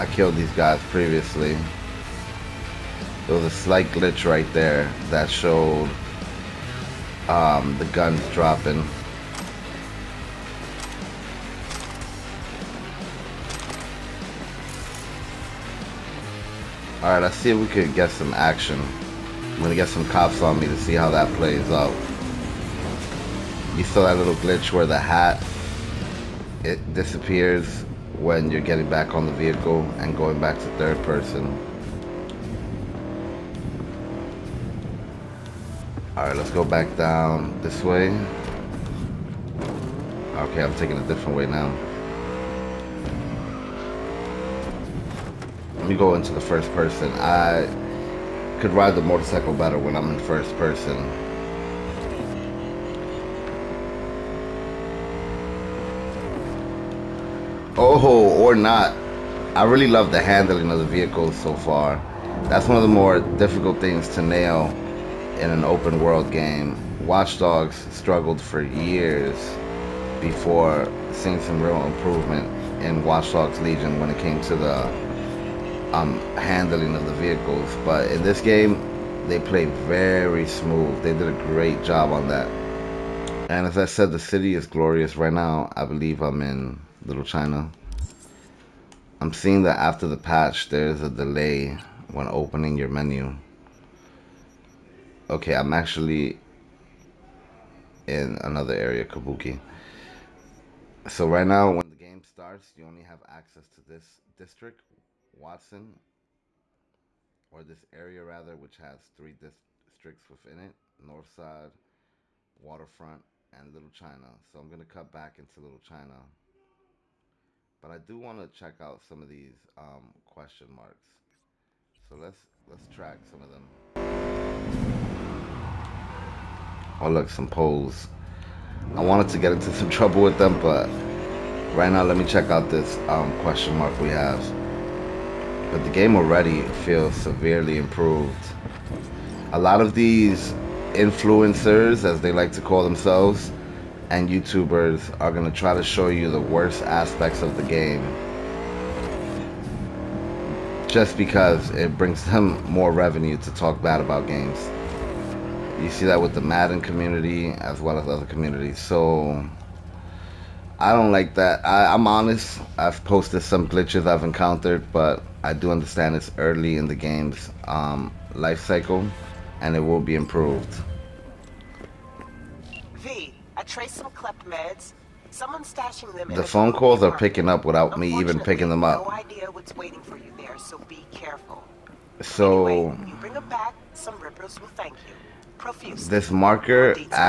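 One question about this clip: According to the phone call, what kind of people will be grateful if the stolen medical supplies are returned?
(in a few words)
rippers.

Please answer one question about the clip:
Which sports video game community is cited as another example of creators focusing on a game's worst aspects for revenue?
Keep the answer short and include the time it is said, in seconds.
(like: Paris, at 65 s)
Madden, at 156 s.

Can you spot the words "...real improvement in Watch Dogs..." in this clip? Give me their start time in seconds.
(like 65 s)
71 s.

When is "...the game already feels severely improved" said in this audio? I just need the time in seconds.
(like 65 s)
135 s.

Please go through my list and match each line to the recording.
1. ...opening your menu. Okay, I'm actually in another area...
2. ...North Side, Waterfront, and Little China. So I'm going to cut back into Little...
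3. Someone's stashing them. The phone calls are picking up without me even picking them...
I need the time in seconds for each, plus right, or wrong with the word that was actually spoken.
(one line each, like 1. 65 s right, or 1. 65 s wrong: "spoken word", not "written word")
1. 92 s right
2. 110 s right
3. 175 s right.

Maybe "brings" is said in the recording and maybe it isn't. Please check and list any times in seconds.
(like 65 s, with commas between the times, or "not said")
151 s, 183 s.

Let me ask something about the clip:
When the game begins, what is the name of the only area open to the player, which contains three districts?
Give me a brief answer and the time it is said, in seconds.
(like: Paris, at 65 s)
Watson, at 105 s.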